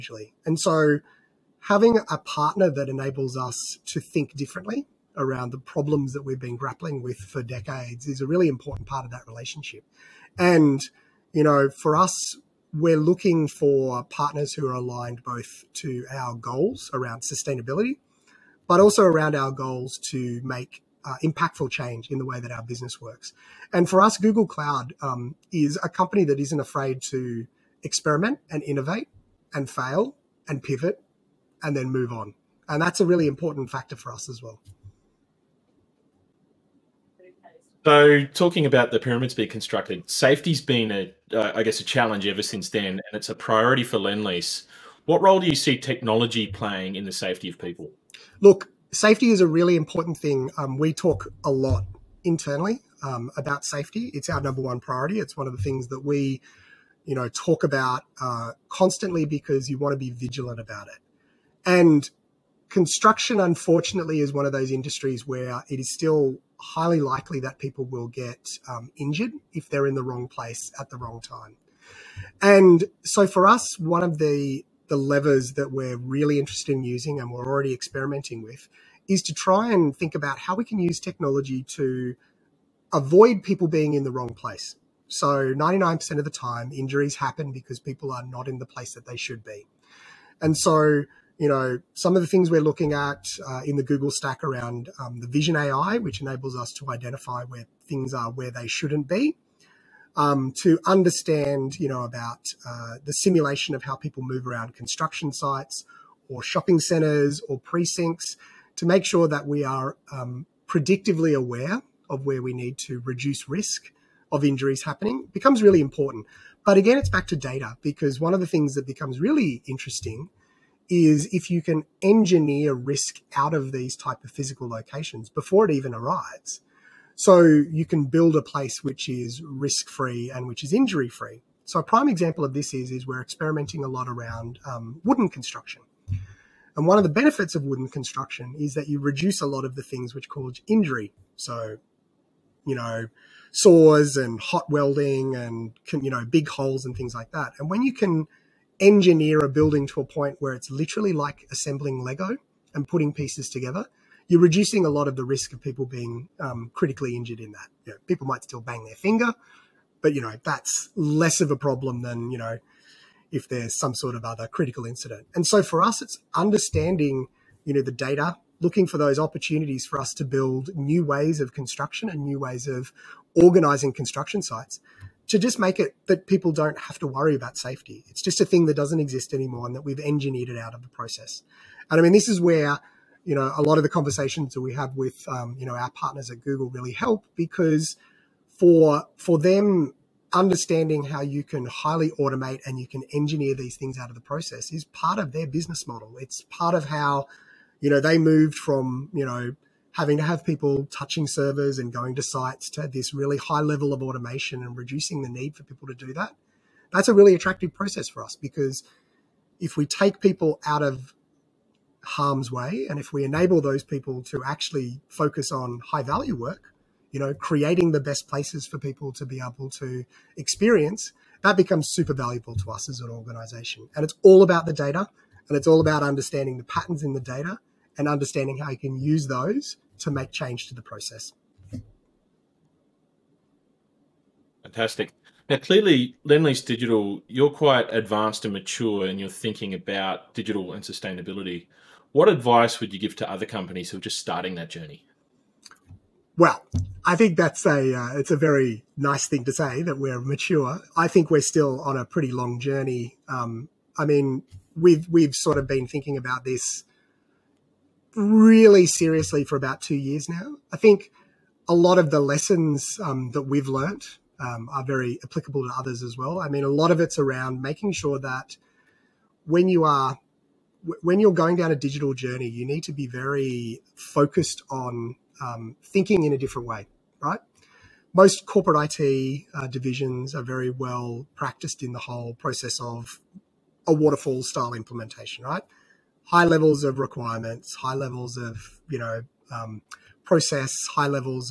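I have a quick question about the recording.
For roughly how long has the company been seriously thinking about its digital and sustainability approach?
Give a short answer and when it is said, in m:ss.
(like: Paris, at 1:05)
2 years, at 4:19.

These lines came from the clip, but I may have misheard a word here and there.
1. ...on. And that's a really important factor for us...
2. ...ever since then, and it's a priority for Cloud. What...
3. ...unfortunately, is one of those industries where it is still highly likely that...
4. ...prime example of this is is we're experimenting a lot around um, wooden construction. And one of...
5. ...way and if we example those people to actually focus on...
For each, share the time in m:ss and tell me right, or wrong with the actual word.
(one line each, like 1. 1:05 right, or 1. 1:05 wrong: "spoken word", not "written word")
1. 0:32 right
2. 0:42 wrong: "Lendlease", not "Cloud"
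3. 1:03 right
4. 2:11 right
5. 3:32 wrong: "enable", not "example".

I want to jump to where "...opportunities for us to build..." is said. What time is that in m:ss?
2:49.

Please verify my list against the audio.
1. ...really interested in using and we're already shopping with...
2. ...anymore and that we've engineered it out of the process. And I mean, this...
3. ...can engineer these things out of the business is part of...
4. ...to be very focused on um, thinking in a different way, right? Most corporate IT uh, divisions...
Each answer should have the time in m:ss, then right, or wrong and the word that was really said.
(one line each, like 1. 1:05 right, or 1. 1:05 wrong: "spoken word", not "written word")
1. 1:15 wrong: "experimenting", not "shopping"
2. 2:59 right
3. 3:12 wrong: "process", not "business"
4. 4:32 right.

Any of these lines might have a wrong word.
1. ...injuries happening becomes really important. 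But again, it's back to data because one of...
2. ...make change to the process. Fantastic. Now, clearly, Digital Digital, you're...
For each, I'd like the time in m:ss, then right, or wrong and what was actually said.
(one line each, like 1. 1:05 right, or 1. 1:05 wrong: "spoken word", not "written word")
1. 1:54 right
2. 3:50 wrong: "Lendlease", not "Digital".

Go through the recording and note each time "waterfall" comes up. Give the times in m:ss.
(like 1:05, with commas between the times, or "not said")
4:43.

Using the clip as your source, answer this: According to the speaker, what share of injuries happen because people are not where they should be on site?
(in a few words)
99%.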